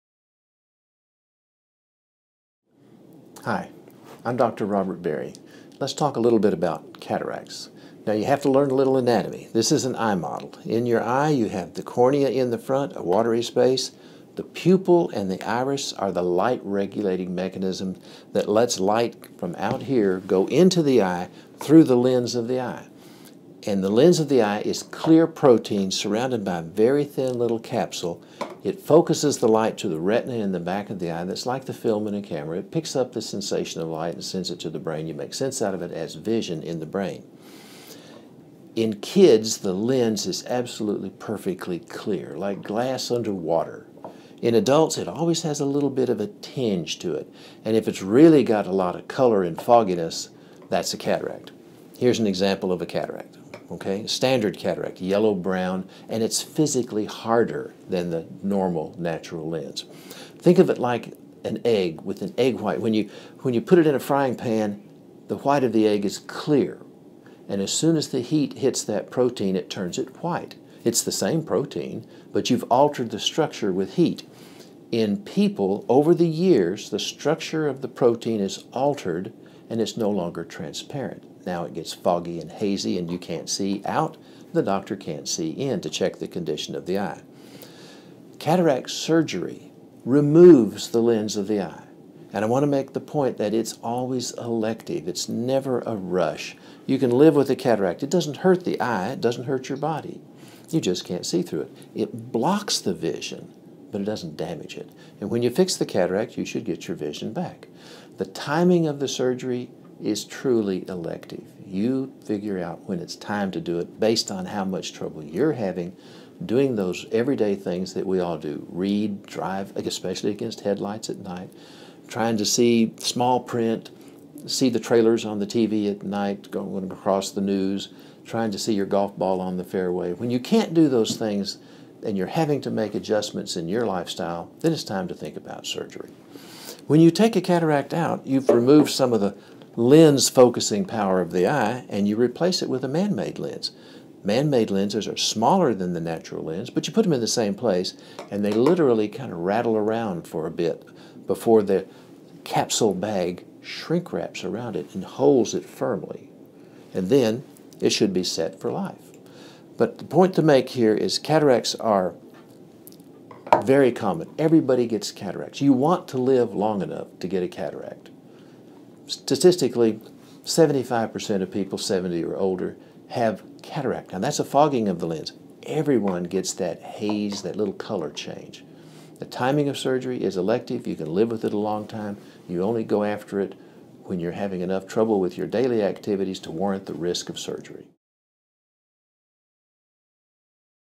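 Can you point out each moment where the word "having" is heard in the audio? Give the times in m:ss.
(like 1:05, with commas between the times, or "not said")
1:55, 2:12, 3:04.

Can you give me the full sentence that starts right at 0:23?
And the lens of the eye is clear protein surrounded by a very thin little capsule.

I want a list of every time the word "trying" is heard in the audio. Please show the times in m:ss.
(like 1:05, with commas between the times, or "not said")
2:02, 2:08.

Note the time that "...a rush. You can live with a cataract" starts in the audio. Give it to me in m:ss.
1:35.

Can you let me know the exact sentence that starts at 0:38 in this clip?
In kids, the lens is absolutely perfectly clear, like glass under water.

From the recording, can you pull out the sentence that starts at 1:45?
And when you fix the cataract, you should get your vision back.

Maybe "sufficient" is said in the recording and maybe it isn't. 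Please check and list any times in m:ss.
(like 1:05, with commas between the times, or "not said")
not said.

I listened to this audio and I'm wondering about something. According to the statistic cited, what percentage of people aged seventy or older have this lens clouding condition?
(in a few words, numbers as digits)
75%.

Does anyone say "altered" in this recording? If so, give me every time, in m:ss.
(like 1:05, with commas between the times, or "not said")
1:12, 1:18.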